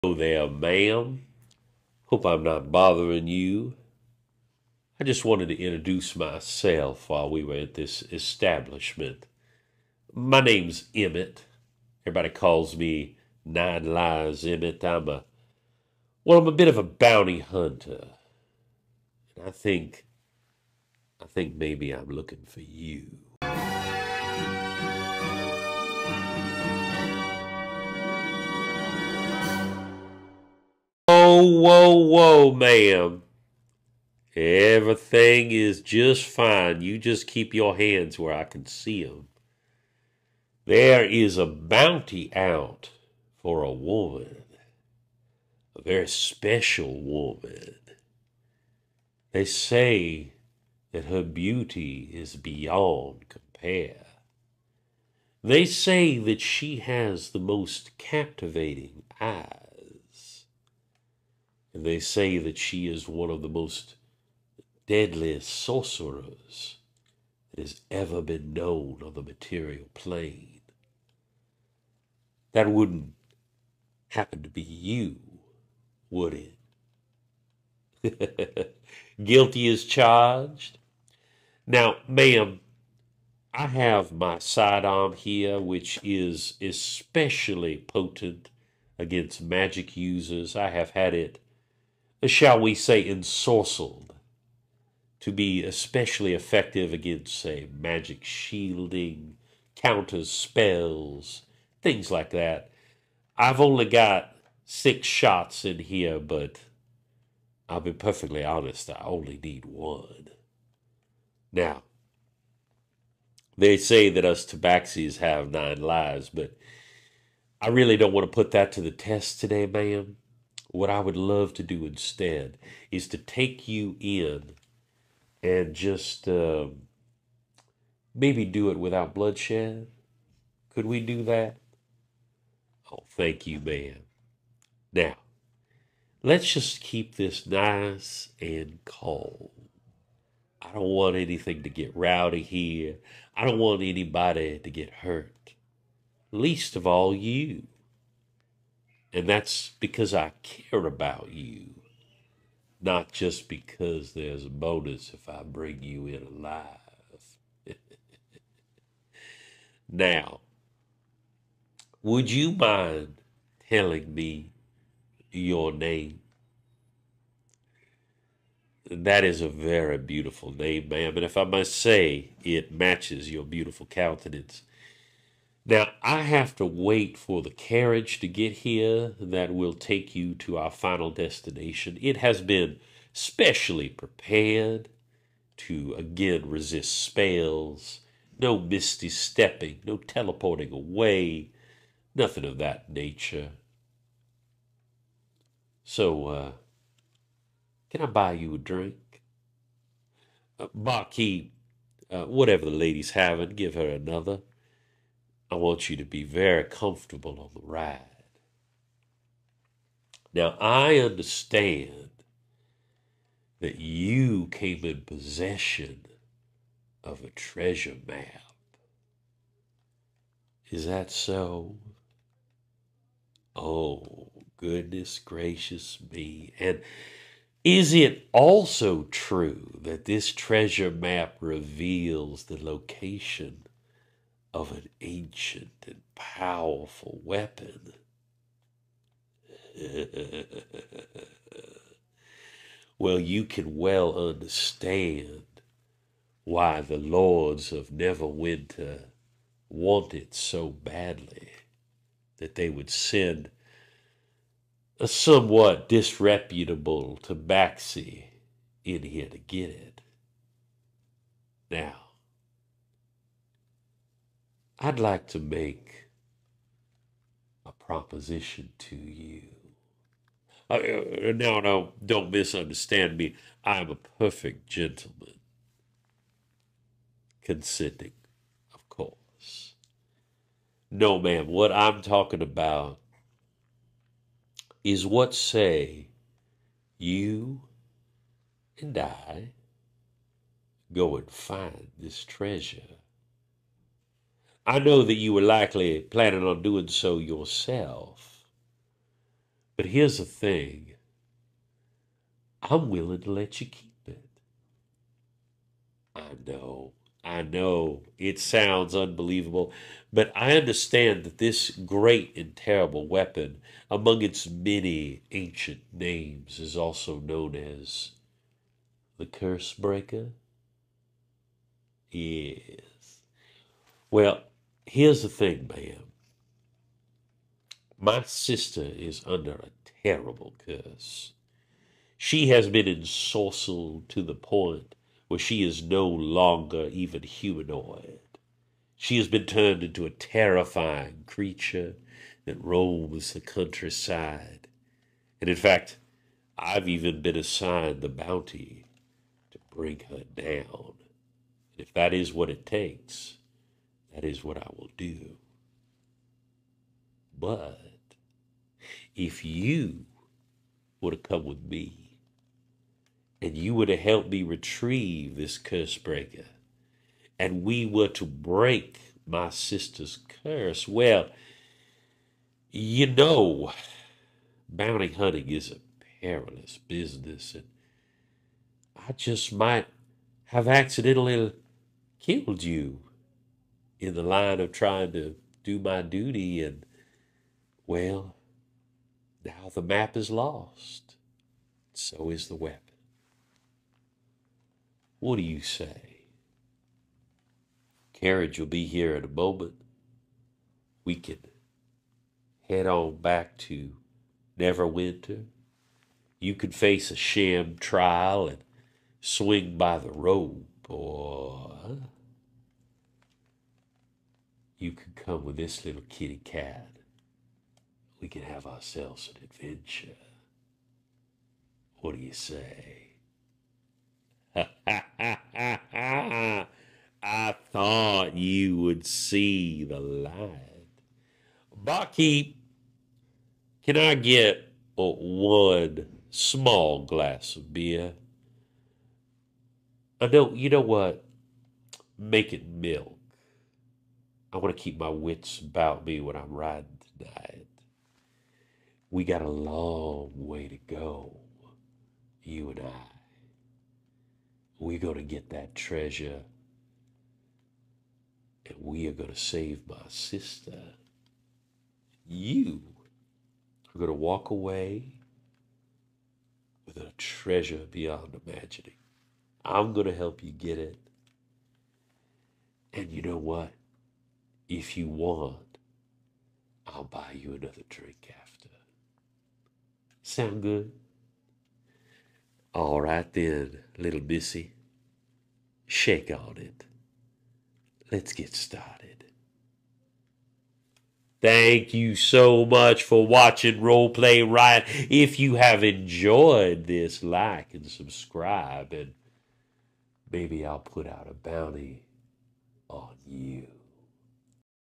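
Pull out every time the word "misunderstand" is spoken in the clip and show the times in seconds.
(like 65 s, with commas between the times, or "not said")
272 s.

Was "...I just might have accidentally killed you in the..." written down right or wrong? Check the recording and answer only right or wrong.
right.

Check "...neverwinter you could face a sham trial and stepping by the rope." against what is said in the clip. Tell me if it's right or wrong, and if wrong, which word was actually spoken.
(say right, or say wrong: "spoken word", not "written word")
wrong: "swing", not "stepping".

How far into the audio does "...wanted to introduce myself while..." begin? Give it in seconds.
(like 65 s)
5 s.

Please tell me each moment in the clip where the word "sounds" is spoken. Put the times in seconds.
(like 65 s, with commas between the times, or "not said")
308 s, 480 s.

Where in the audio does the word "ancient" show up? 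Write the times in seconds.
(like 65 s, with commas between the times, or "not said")
235 s, 315 s.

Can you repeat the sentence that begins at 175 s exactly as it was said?
That I have to wait for the carriage to get here that will take you to our final destination.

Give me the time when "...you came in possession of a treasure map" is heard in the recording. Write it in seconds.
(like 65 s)
213 s.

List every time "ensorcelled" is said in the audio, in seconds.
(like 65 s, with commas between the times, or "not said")
93 s, 332 s.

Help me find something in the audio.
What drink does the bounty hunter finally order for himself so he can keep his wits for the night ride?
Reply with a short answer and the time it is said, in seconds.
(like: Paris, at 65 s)
Milk, at 442 s.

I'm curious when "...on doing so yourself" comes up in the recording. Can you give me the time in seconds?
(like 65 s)
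296 s.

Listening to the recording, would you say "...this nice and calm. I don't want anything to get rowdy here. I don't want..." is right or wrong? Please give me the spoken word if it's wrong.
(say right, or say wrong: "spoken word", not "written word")
right.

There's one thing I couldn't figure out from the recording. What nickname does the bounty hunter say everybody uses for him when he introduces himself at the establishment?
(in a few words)
Nine Lives Emmett.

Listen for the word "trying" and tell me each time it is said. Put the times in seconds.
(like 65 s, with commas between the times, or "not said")
384 s.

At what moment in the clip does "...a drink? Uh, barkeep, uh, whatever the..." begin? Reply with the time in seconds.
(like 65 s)
198 s.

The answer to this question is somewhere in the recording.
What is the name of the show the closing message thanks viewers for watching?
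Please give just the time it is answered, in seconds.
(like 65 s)
493 s.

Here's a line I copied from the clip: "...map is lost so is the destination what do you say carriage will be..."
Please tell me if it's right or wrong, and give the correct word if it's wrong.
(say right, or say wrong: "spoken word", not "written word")
wrong: "weapon", not "destination".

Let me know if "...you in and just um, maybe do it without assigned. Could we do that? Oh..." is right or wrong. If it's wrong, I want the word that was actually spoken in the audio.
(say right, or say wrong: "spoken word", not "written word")
wrong: "bloodshed", not "assigned".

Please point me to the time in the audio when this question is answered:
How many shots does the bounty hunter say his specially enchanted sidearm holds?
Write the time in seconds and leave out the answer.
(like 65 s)
104 s.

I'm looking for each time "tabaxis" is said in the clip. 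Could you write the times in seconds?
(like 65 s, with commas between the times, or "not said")
114 s, 257 s.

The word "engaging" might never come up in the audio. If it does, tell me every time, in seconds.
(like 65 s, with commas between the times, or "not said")
not said.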